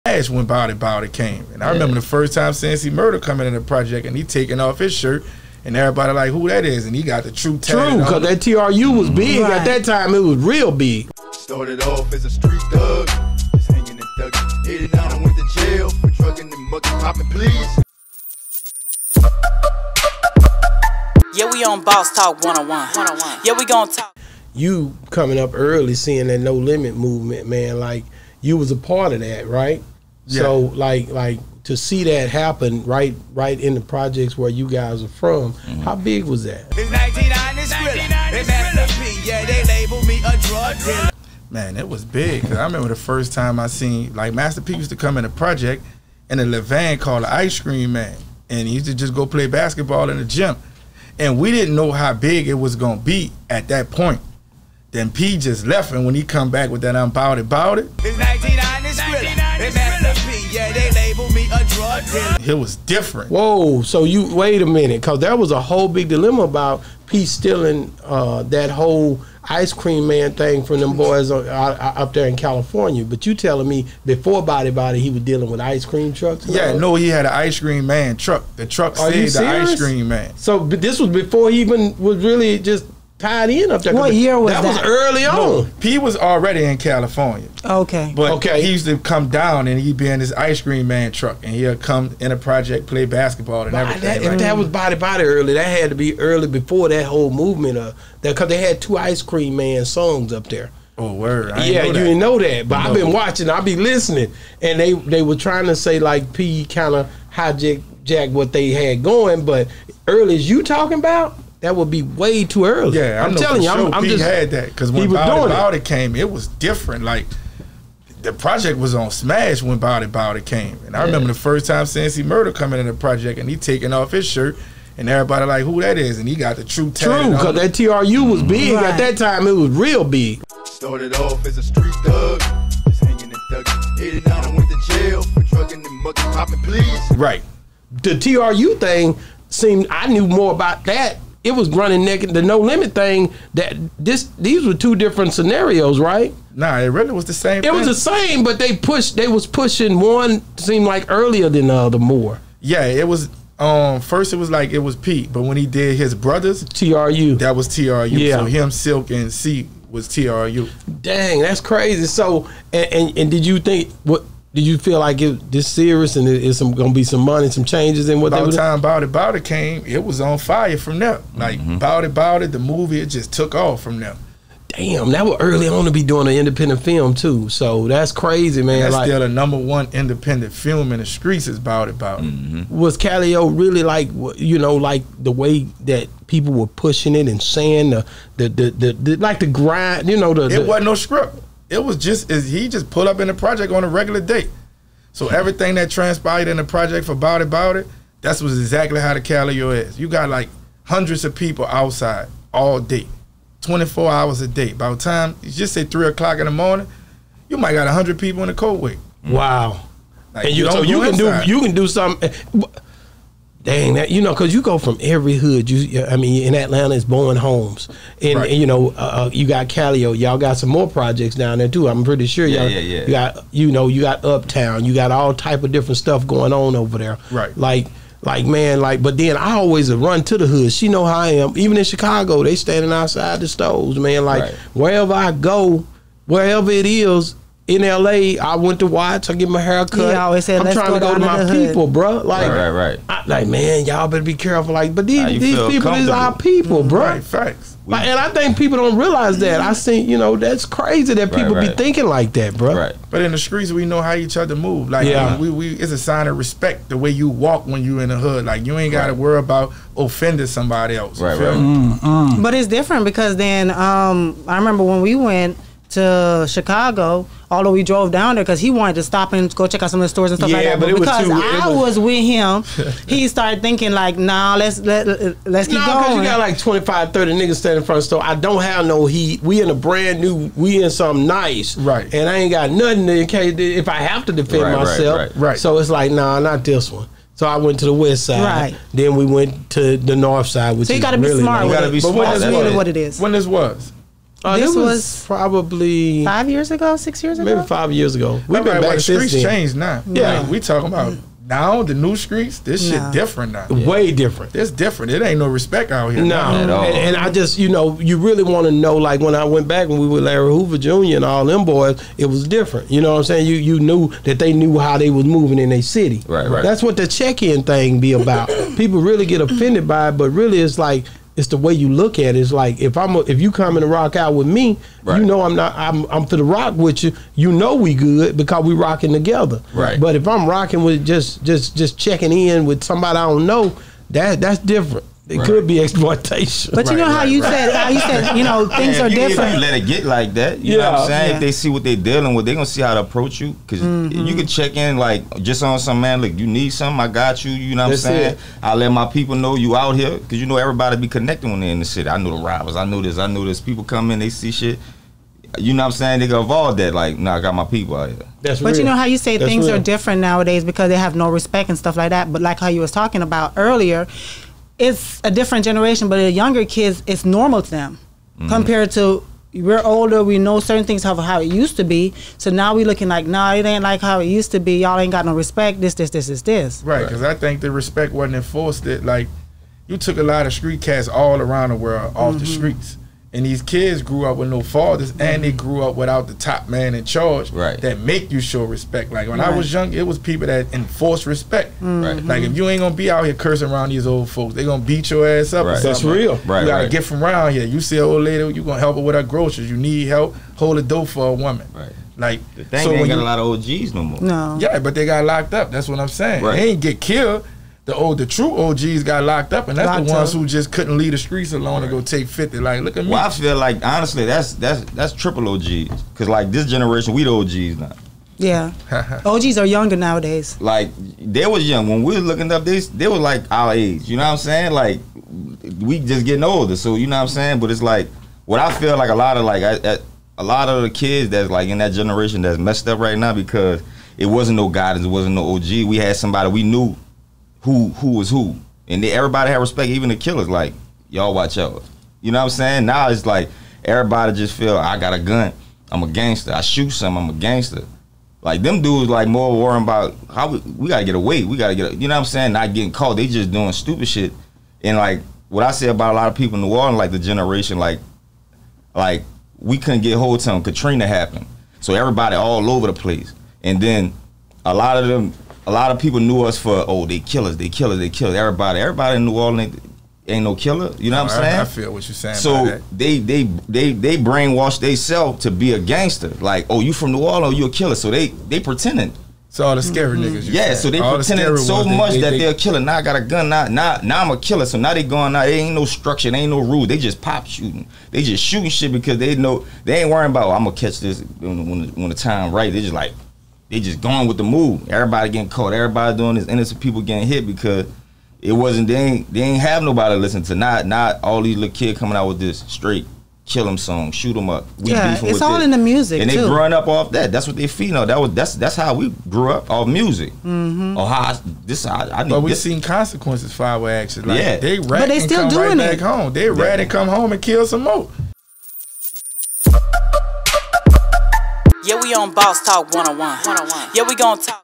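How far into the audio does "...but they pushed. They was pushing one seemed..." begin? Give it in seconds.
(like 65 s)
148 s.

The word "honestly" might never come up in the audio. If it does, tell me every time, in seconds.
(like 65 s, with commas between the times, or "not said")
413 s.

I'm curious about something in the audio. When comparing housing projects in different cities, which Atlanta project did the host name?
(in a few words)
Bowen Homes.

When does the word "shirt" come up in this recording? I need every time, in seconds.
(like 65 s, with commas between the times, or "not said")
4 s, 124 s.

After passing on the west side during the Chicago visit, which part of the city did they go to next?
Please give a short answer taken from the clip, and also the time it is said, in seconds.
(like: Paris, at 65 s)
North side, at 290 s.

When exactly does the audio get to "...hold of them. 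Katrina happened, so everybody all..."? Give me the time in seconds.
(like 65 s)
460 s.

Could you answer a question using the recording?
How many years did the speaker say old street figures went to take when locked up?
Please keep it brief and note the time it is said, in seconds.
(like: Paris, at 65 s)
50, at 412 s.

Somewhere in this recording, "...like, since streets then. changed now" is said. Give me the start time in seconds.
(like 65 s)
298 s.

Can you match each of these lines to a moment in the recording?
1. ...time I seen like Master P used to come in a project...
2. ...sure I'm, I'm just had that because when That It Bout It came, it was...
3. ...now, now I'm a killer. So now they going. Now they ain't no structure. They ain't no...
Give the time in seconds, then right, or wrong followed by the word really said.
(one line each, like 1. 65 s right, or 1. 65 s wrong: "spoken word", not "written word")
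1. 43 s right
2. 113 s wrong: "Bout", not "That"
3. 483 s right.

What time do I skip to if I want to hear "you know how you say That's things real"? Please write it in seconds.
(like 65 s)
358 s.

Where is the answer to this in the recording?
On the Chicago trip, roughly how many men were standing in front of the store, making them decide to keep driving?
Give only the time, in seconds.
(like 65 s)
276 s.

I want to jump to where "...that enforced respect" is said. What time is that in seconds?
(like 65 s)
390 s.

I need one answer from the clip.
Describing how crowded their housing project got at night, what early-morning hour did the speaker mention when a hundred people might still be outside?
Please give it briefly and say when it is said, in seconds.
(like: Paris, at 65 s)
3 o'clock, at 205 s.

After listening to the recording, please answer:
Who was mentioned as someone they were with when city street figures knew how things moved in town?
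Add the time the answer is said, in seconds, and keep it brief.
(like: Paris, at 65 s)
Larry Hoover Jr., at 310 s.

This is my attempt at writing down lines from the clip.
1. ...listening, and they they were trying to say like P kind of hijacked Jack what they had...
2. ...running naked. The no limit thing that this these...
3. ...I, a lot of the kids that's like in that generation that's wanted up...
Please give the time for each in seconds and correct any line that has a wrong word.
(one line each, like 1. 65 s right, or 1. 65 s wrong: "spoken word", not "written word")
1. 103 s right
2. 141 s right
3. 429 s wrong: "messed", not "wanted".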